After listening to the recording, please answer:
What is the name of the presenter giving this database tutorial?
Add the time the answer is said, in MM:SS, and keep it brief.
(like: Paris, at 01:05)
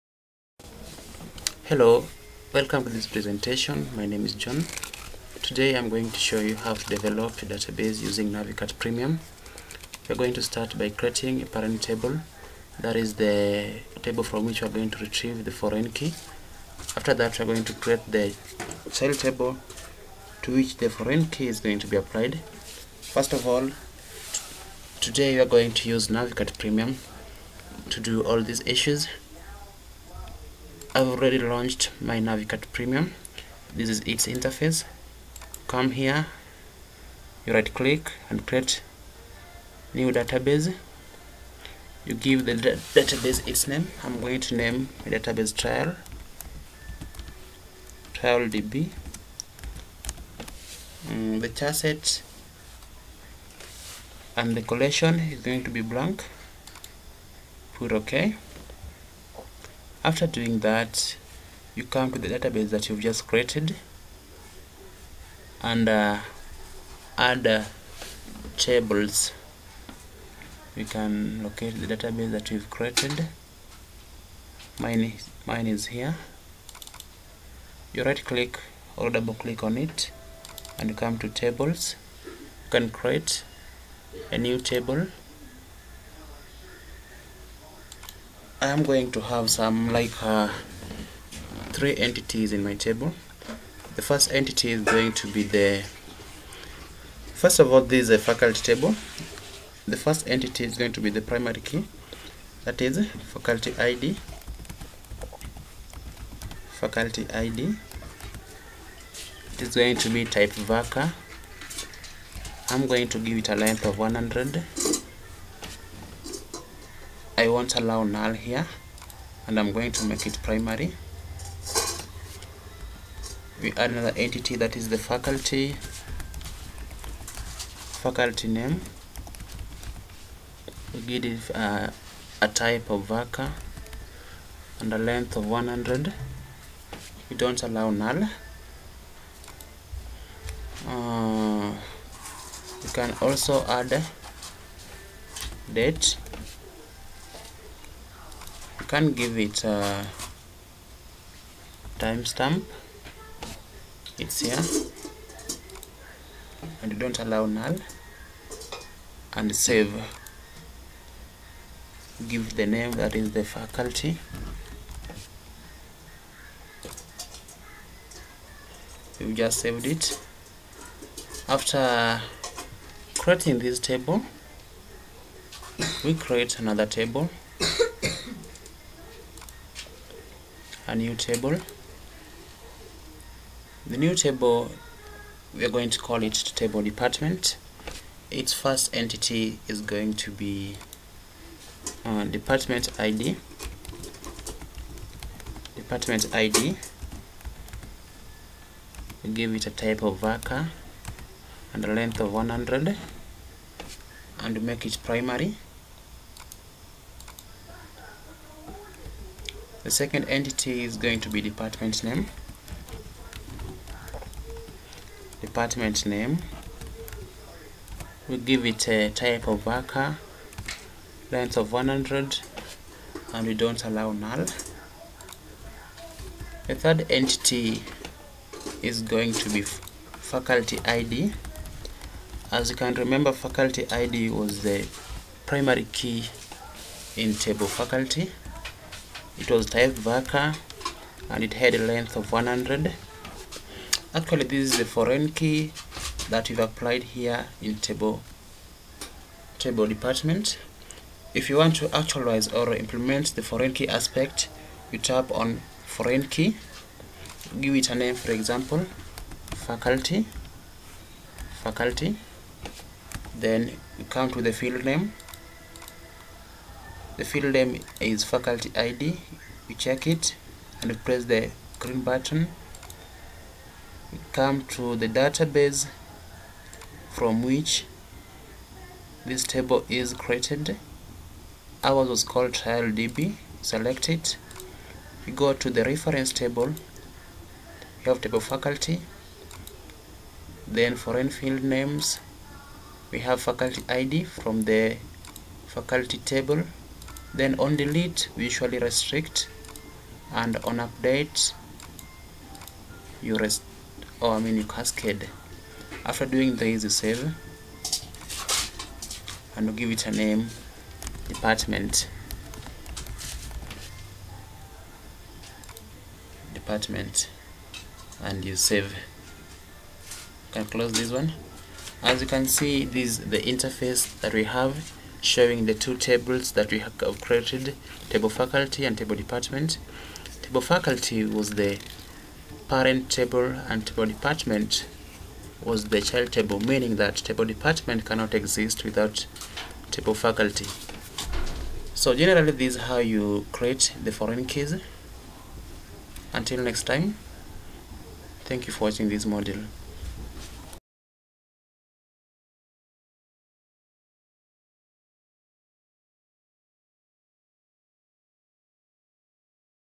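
John, at 00:04.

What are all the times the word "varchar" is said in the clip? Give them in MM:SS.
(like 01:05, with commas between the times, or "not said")
01:50, 02:13, 03:20, 03:39, 04:00.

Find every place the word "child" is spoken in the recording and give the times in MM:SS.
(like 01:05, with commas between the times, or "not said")
00:18, 05:36.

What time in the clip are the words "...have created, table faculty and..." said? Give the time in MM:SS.
05:26.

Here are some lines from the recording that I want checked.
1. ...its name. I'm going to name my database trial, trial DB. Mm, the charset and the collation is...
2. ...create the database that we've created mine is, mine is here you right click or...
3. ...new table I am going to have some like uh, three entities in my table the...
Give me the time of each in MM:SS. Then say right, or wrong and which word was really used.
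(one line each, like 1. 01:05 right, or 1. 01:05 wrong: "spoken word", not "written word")
1. 00:43 right
2. 01:11 wrong: "locate", not "create"
3. 01:24 right.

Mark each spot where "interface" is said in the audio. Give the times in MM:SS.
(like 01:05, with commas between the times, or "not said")
00:34, 05:23.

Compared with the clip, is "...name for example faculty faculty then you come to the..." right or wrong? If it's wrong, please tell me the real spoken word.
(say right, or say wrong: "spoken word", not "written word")
right.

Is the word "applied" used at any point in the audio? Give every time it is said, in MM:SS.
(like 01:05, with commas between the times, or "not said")
00:21, 04:06.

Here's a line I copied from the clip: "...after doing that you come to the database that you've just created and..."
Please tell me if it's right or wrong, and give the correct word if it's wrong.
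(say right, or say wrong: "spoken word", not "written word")
right.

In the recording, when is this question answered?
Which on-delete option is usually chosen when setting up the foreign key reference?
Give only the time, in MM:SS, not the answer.
04:58.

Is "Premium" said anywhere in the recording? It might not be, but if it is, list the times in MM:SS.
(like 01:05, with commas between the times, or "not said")
00:08, 00:26, 00:32.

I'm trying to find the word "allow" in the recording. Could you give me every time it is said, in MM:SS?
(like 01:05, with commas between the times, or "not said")
01:57, 02:17, 02:37, 03:43.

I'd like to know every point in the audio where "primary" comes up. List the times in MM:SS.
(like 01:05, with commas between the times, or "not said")
01:41, 02:00, 03:25, 03:55.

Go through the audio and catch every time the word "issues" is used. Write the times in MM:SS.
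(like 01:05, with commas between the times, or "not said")
00:28.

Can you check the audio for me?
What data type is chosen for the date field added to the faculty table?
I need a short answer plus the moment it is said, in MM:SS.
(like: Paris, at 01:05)
timestamp, at 02:31.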